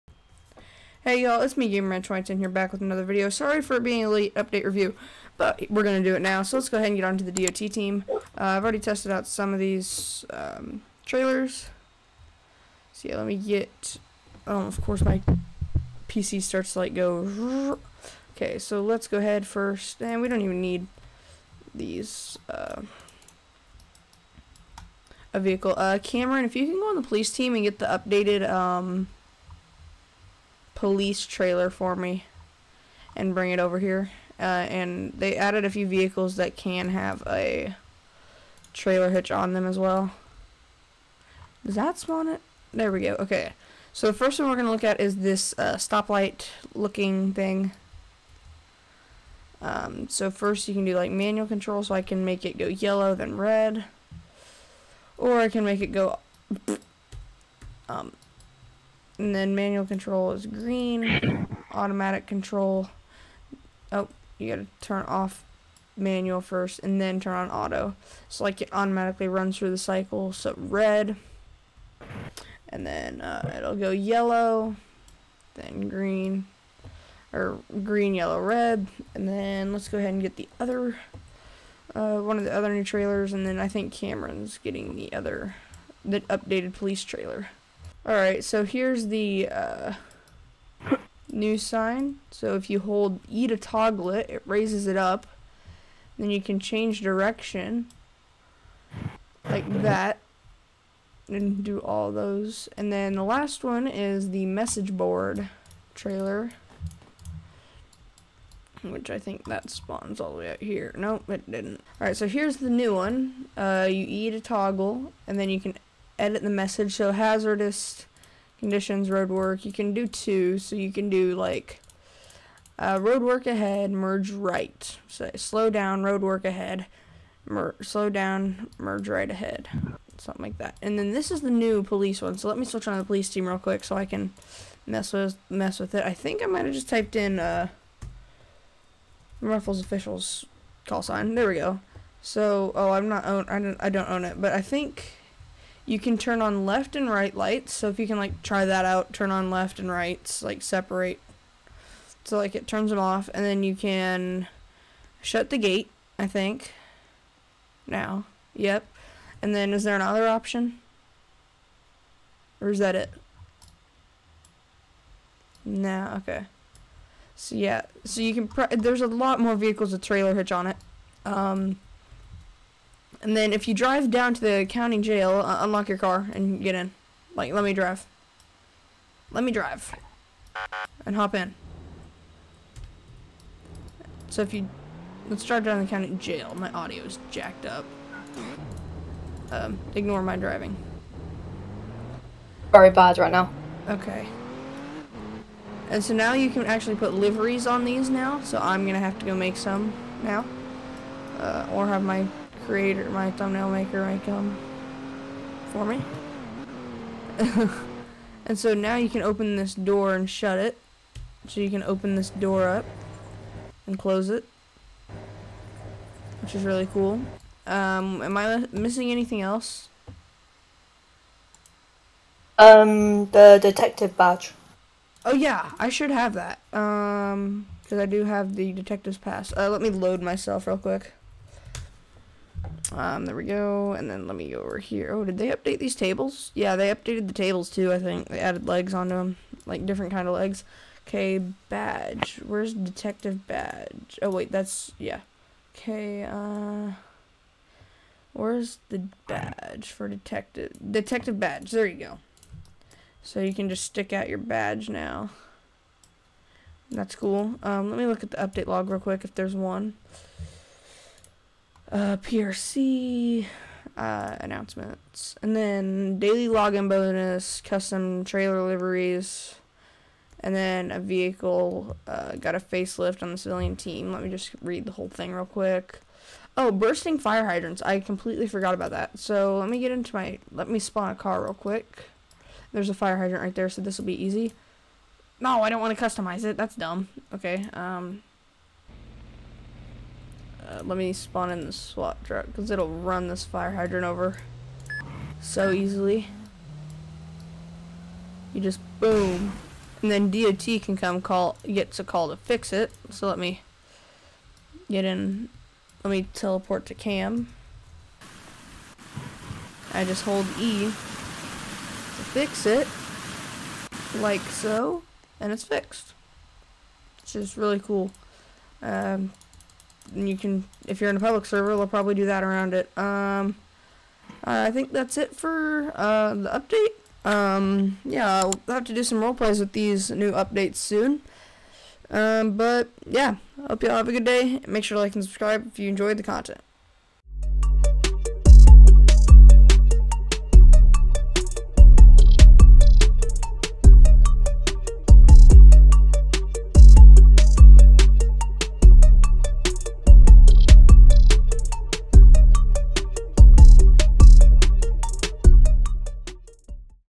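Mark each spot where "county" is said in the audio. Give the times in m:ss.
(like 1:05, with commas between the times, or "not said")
2:54, 3:05.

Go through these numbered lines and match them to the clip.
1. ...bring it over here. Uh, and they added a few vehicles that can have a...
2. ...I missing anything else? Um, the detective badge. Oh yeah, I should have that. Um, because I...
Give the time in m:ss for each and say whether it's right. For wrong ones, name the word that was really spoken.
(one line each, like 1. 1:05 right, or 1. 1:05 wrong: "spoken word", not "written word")
1. 0:33 right
2. 3:38 right.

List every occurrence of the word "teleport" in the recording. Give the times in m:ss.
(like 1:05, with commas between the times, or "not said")
5:06.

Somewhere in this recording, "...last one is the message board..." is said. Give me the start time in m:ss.
1:43.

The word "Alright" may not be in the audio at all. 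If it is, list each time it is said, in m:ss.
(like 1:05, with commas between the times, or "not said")
1:28, 1:51.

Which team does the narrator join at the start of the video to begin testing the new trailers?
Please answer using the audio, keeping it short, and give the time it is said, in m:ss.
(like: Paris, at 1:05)
DOT team, at 0:07.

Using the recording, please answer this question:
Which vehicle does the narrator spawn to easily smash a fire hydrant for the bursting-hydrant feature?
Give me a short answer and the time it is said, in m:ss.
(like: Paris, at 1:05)
SWAT truck, at 4:51.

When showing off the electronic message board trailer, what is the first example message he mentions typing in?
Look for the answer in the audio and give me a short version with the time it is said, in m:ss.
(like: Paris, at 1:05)
Hazardous conditions, at 1:57.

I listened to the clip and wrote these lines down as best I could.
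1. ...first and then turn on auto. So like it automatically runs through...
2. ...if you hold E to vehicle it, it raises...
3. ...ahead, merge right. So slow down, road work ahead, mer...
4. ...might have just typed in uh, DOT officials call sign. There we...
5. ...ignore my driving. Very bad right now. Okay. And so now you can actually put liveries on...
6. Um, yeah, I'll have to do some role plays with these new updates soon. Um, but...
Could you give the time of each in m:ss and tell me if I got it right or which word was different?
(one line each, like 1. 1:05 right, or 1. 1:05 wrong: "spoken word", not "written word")
1. 1:06 right
2. 1:32 wrong: "toggle", not "vehicle"
3. 2:03 right
4. 2:16 wrong: "Ruffles", not "DOT"
5. 3:09 right
6. 5:27 right.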